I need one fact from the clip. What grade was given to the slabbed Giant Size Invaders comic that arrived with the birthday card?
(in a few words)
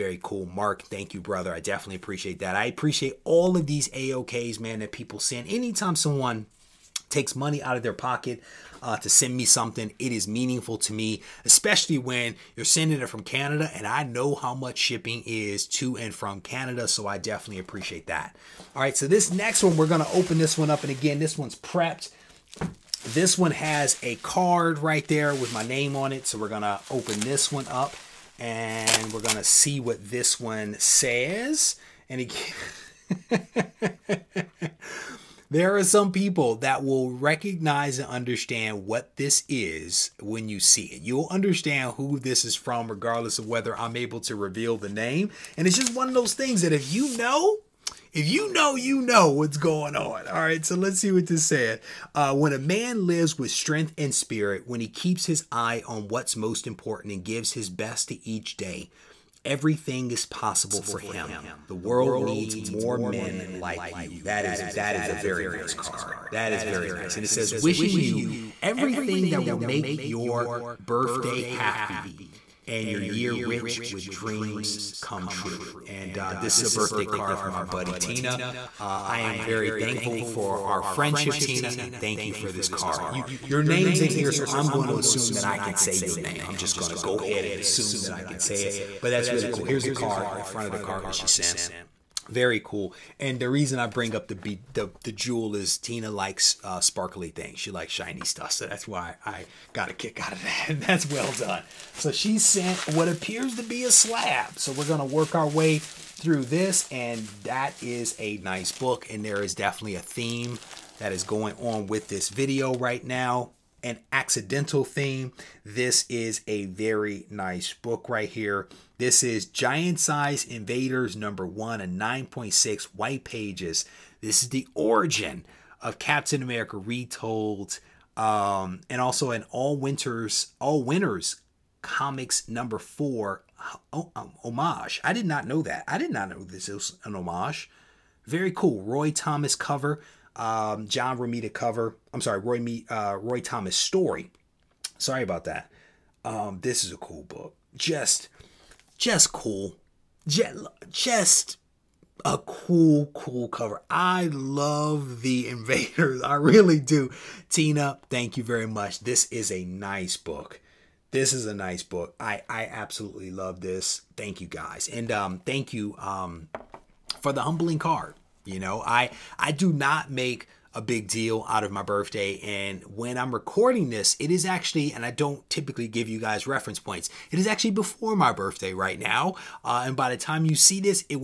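9.6.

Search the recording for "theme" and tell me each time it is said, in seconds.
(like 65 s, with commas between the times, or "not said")
110 s, 114 s.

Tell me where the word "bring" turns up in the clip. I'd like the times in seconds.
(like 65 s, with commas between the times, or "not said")
93 s.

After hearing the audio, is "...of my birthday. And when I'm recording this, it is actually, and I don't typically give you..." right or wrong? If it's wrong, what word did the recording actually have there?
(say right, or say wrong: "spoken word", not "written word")
right.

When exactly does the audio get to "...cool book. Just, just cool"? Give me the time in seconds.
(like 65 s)
146 s.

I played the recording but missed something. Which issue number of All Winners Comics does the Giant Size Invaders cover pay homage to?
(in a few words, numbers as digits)
4.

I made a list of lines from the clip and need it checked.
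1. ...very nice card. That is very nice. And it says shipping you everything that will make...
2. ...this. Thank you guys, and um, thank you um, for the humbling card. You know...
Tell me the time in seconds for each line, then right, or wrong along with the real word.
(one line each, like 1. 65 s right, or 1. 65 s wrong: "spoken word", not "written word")
1. 65 s wrong: "wishing", not "shipping"
2. 163 s right.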